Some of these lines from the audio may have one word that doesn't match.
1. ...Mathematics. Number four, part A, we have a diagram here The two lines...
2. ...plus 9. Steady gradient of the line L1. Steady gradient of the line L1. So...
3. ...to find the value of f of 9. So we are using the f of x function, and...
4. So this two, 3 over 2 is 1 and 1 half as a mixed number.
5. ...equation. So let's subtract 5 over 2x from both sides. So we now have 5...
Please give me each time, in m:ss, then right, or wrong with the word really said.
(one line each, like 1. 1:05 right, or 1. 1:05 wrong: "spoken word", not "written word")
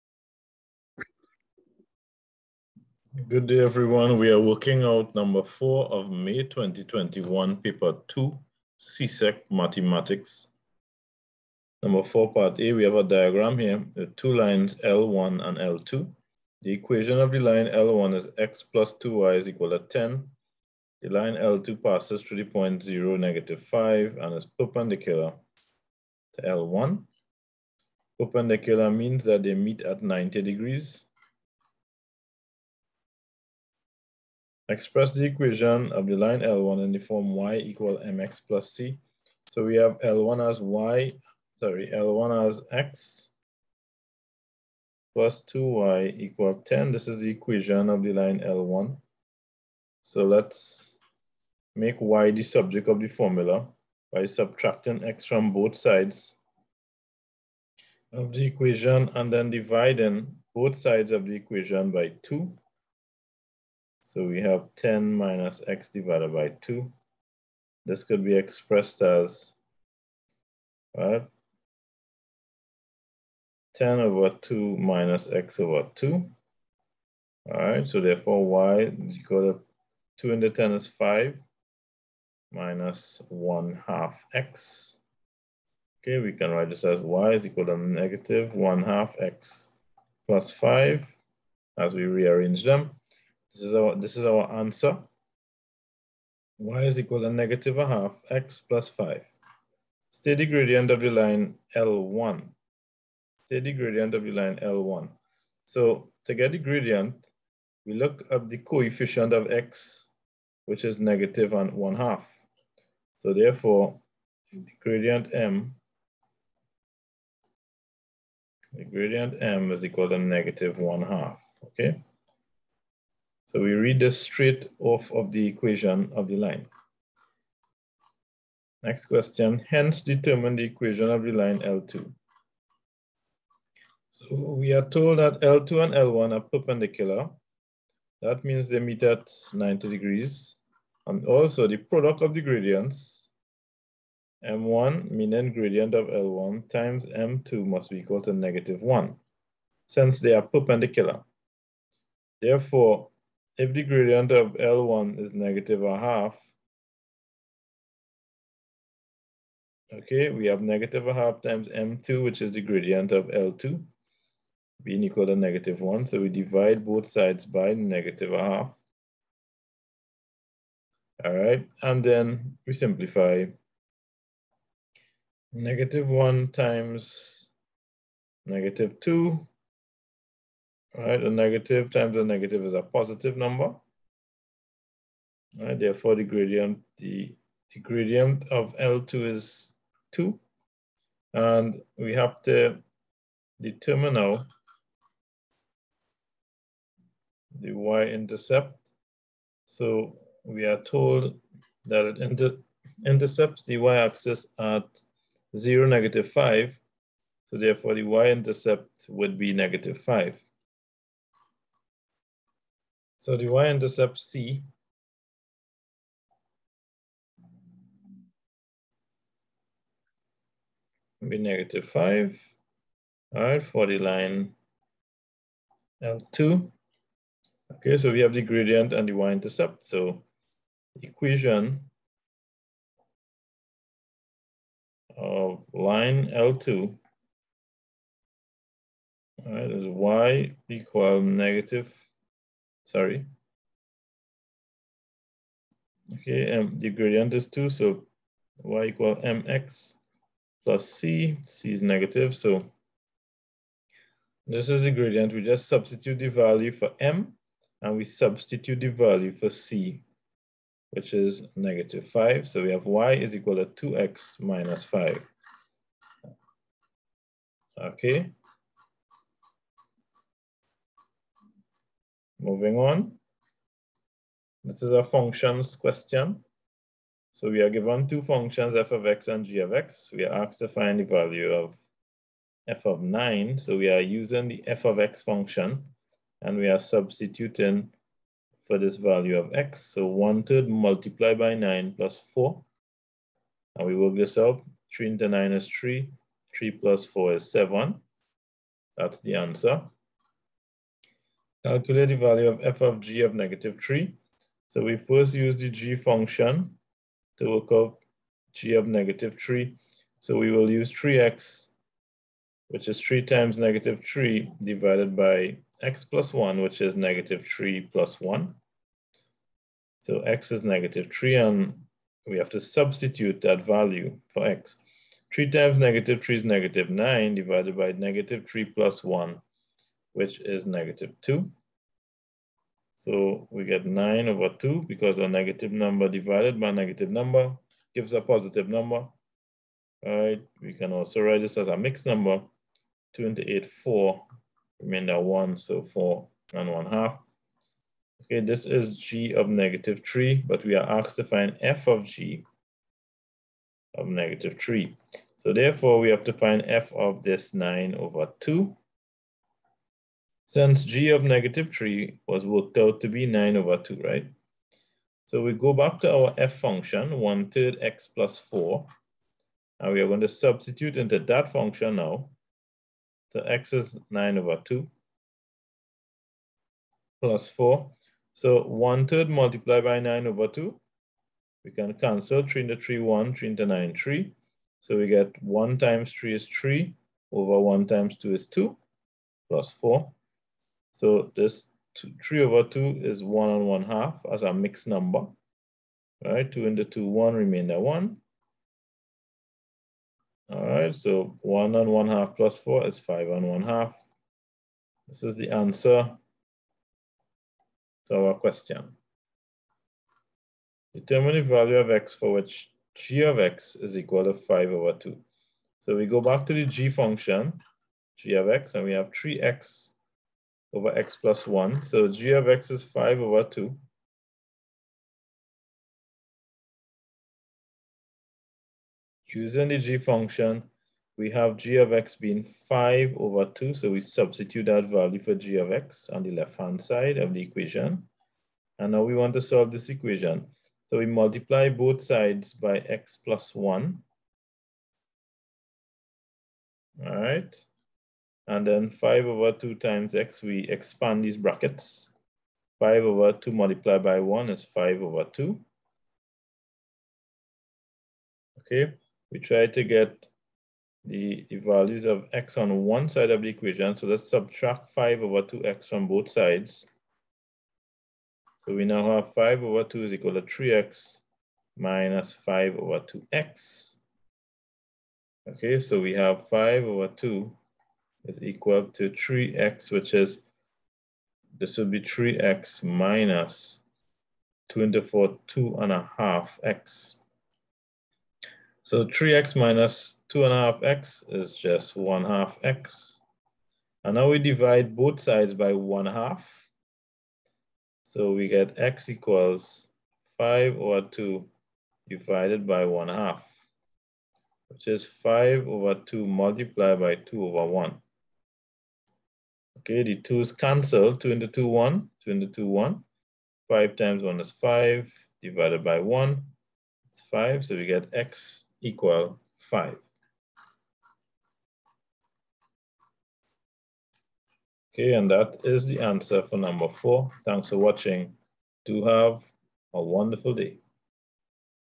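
1. 0:09 right
2. 1:38 wrong: "5", not "9"
3. 4:40 right
4. 6:30 right
5. 7:43 right.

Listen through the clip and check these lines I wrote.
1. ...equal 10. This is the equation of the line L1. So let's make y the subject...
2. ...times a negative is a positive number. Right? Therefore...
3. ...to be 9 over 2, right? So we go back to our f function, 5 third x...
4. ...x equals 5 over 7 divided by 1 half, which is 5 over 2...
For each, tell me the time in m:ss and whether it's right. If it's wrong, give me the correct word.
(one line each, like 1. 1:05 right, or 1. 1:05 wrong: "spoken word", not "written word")
1. 0:46 right
2. 3:01 right
3. 6:03 wrong: "1", not "5"
4. 8:18 wrong: "2", not "7".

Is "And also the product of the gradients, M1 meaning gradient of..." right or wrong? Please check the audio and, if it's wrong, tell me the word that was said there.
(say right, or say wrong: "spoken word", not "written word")
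right.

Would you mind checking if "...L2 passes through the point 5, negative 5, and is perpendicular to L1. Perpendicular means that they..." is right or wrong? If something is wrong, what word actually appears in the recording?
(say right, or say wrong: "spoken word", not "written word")
wrong: "0", not "5".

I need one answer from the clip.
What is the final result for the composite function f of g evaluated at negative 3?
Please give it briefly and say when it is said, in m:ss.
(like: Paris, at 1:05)
5 1/2, at 6:42.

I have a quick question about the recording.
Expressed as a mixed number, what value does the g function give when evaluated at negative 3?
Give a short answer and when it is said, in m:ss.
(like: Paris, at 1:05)
4 1/2, at 5:45.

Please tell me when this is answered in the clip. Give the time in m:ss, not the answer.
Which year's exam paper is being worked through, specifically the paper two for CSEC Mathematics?
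0:06.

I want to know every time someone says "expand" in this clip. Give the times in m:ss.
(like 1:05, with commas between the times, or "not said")
7:30.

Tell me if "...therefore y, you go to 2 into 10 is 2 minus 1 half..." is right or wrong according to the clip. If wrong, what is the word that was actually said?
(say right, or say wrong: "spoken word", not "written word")
wrong: "5", not "2".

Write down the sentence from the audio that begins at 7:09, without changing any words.
Using the g function, we have g of x being 5 over 2.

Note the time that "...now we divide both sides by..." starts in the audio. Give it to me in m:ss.
8:14.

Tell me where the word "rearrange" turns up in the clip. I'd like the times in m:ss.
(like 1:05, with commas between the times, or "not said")
1:32.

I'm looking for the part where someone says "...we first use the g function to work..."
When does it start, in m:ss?
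5:04.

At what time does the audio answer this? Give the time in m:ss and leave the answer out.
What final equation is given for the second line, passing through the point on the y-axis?
4:22.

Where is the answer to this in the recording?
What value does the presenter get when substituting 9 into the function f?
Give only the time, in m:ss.
4:57.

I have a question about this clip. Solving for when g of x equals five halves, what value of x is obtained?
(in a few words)
5.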